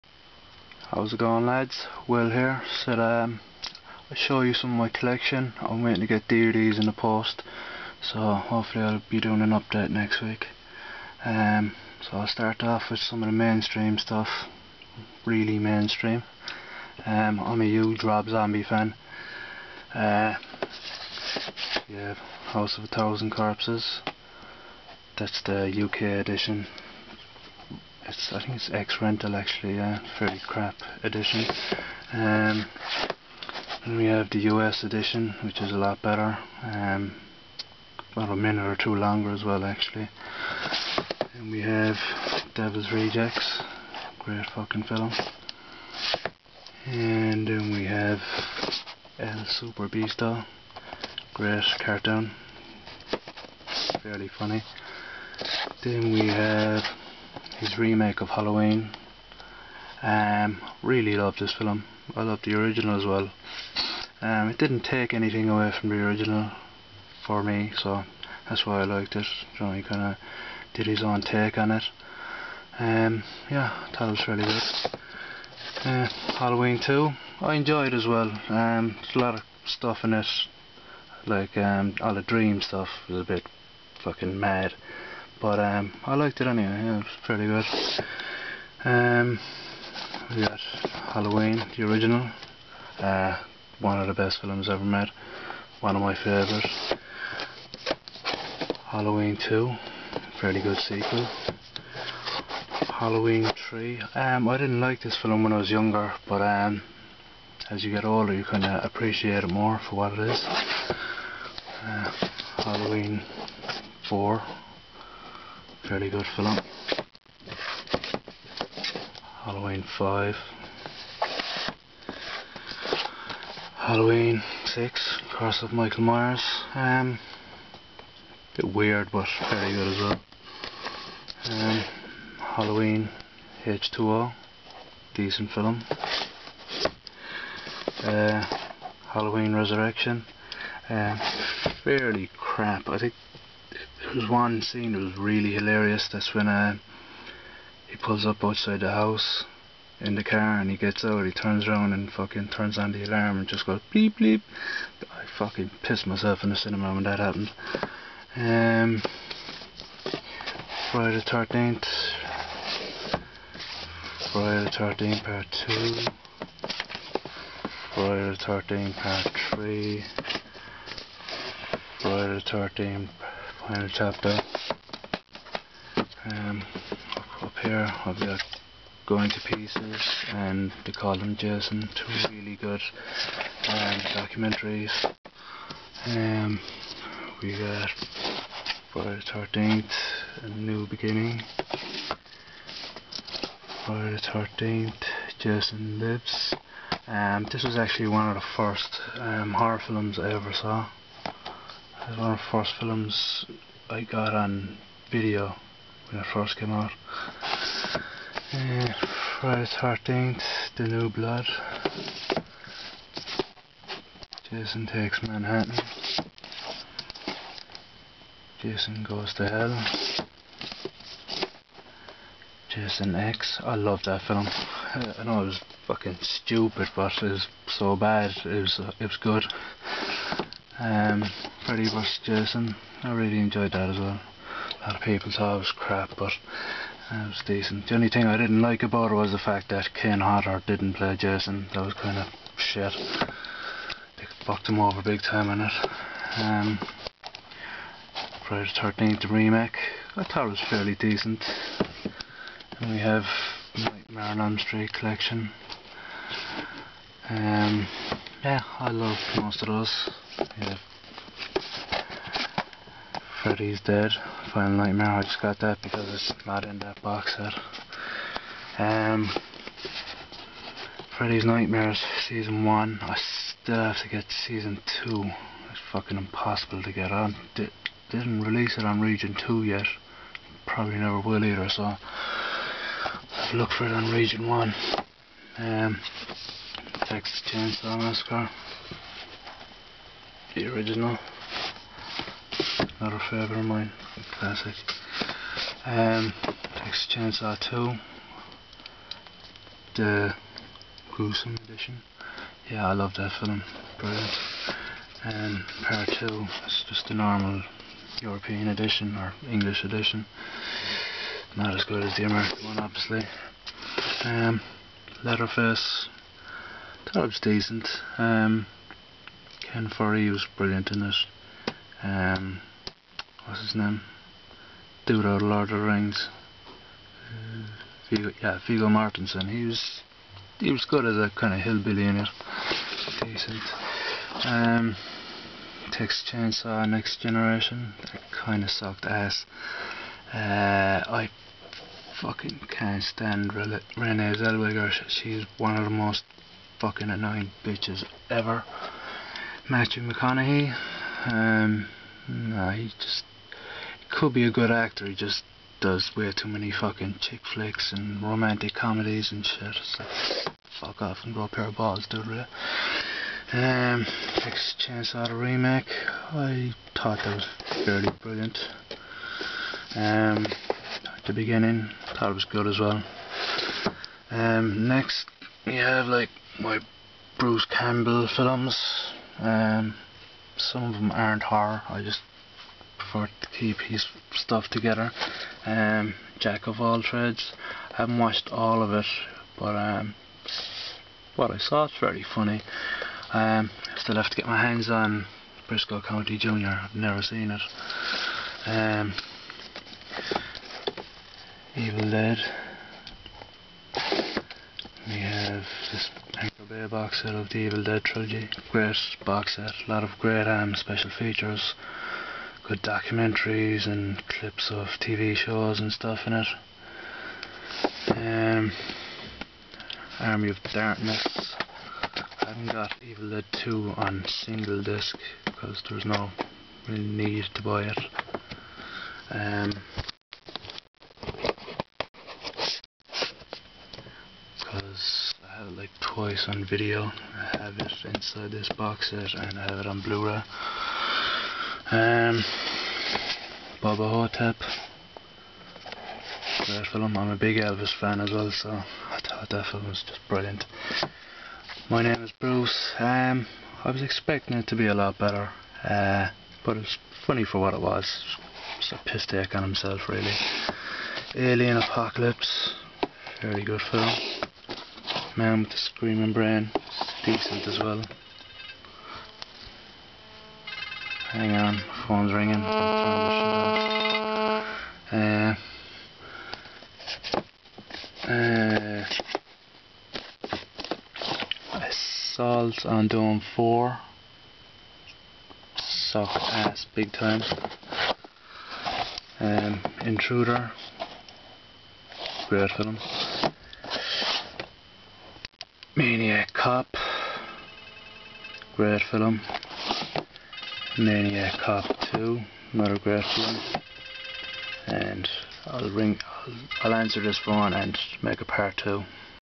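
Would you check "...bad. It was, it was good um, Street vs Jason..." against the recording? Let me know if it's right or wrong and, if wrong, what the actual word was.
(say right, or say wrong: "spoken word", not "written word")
wrong: "Freddy", not "Street".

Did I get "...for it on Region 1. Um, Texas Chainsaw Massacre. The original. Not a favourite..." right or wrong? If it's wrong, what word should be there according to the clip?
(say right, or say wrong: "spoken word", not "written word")
right.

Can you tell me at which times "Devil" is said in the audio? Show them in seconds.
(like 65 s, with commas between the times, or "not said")
42 s.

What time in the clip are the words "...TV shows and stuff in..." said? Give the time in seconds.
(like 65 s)
415 s.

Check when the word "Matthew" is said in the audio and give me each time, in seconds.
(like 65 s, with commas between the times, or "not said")
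349 s.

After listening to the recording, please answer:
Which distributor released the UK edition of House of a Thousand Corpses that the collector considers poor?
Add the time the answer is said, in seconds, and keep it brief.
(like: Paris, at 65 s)
X Rental, at 28 s.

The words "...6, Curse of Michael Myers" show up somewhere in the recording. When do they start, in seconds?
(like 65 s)
124 s.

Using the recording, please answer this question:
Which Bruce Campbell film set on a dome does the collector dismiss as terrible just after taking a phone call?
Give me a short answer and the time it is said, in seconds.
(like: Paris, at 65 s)
Assault on Dome 4, at 481 s.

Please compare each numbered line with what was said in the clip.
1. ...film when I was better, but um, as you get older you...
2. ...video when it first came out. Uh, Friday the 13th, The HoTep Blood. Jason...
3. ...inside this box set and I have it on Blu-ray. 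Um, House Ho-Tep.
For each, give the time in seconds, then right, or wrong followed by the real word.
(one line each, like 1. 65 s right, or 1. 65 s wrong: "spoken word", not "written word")
1. 105 s wrong: "younger", not "better"
2. 205 s wrong: "New", not "HoTep"
3. 438 s wrong: "Bubba", not "House".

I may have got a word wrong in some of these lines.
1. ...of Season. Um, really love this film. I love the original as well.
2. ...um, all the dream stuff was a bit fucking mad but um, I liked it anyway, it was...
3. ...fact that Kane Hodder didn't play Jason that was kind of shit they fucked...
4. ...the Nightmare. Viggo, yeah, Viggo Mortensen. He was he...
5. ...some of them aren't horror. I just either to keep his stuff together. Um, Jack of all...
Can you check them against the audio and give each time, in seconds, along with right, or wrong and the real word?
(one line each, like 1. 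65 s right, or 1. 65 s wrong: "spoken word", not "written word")
1. 58 s wrong: "Halloween", not "Season"
2. 81 s right
3. 239 s right
4. 325 s wrong: "Rings", not "Nightmare"
5. 380 s wrong: "prefer", not "either".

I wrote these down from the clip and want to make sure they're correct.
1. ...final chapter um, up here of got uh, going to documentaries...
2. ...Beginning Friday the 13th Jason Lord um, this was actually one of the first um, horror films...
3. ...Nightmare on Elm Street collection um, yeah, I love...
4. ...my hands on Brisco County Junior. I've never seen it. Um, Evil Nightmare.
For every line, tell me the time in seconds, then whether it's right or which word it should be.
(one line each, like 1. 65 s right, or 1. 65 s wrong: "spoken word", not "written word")
1. 173 s wrong: "pieces", not "documentaries"
2. 190 s wrong: "Lives", not "Lord"
3. 253 s right
4. 394 s wrong: "Dead", not "Nightmare".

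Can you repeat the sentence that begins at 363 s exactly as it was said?
Um, chance out of remake, I thought that was fairly brilliant.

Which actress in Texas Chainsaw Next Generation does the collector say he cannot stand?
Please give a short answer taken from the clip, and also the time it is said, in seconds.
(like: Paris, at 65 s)
Renee Zellweger, at 343 s.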